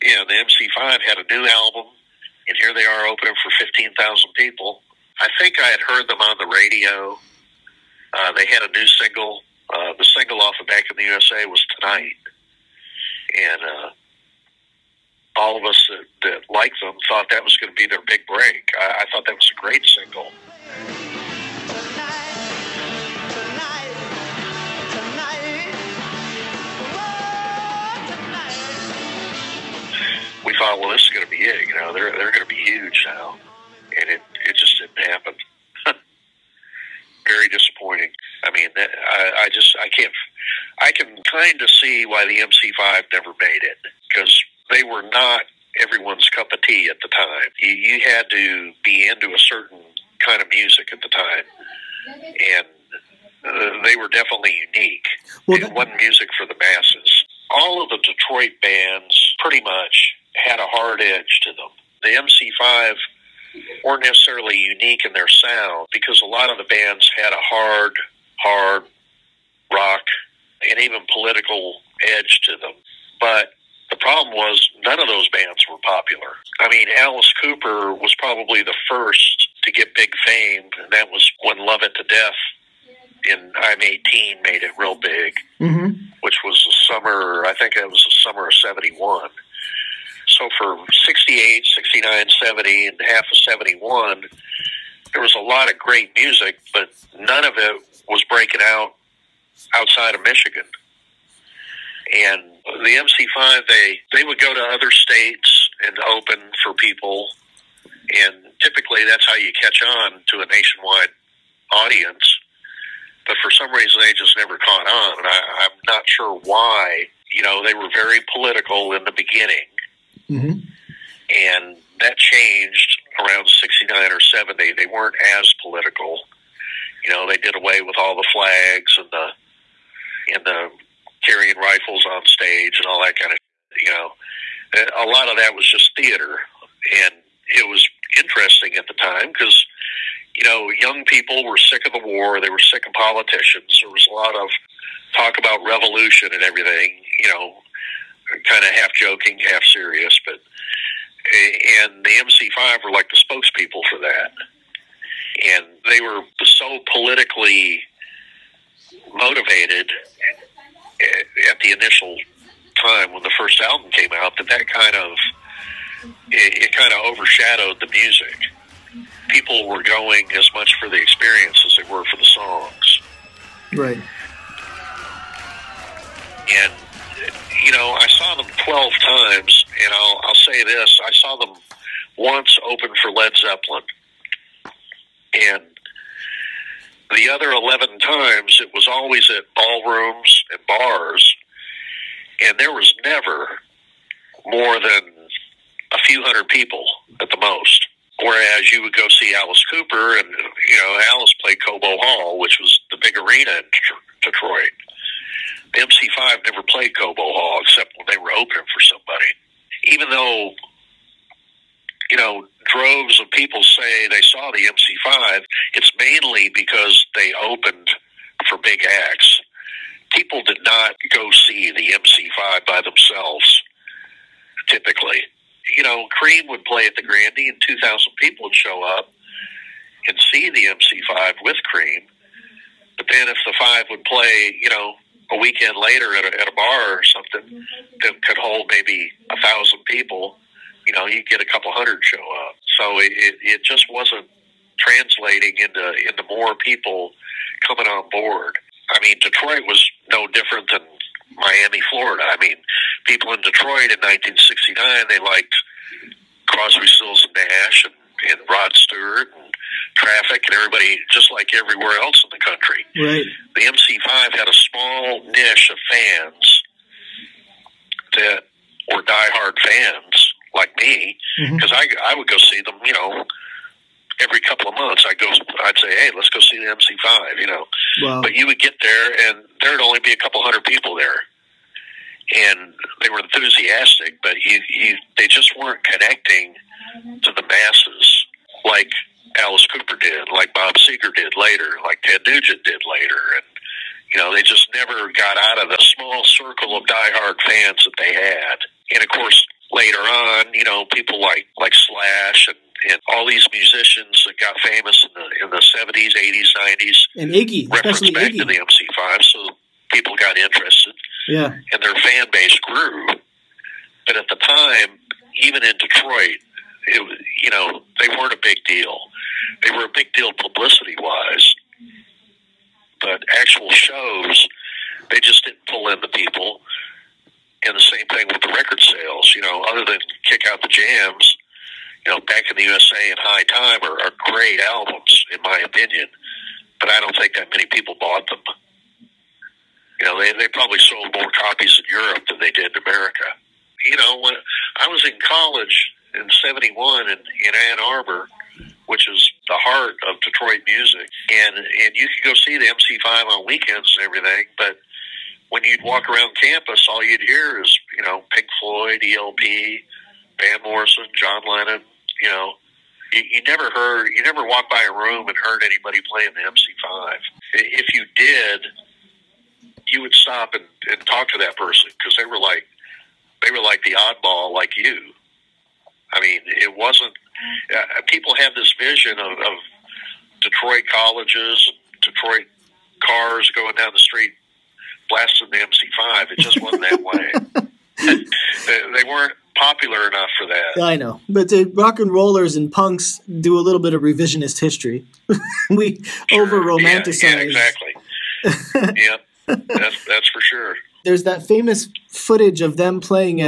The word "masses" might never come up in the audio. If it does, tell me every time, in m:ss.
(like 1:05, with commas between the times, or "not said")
0:56, 4:47.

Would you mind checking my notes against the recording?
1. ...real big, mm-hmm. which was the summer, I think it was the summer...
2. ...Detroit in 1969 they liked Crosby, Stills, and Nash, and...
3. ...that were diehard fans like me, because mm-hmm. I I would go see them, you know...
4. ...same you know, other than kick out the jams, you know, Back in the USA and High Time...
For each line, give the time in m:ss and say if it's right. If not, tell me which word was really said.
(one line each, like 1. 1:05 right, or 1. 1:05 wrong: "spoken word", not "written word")
1. 1:24 right
2. 4:13 right
3. 4:28 right
4. 5:27 right.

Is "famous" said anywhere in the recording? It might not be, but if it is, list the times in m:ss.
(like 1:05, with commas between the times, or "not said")
5:04, 6:41.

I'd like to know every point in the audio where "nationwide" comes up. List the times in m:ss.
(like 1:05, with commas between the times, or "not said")
1:50.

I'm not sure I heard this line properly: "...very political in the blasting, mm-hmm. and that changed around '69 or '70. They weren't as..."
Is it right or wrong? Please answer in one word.
wrong.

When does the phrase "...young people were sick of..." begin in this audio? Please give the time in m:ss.
2:20.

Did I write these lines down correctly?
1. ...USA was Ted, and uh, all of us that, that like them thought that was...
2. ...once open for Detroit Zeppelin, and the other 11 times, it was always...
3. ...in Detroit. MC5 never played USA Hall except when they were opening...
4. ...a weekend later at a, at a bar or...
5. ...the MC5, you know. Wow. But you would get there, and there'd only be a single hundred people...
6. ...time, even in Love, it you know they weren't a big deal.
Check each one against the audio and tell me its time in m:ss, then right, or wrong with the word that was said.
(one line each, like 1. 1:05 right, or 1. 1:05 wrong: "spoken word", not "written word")
1. 0:11 wrong: "Tonight", not "Ted"
2. 3:02 wrong: "Led", not "Detroit"
3. 3:23 wrong: "Cobo", not "USA"
4. 3:55 right
5. 4:36 wrong: "couple", not "single"
6. 5:14 wrong: "Detroit", not "Love".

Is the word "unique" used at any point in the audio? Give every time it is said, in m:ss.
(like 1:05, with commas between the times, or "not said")
0:54, 1:04.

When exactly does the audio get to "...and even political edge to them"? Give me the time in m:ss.
1:10.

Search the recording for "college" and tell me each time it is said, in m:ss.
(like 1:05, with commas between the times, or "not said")
5:45, 6:20.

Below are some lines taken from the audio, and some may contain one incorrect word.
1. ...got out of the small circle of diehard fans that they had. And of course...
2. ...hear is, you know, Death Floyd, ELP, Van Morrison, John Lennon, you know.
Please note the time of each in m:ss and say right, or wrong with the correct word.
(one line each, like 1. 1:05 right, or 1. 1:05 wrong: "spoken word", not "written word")
1. 4:55 right
2. 5:57 wrong: "Pink", not "Death".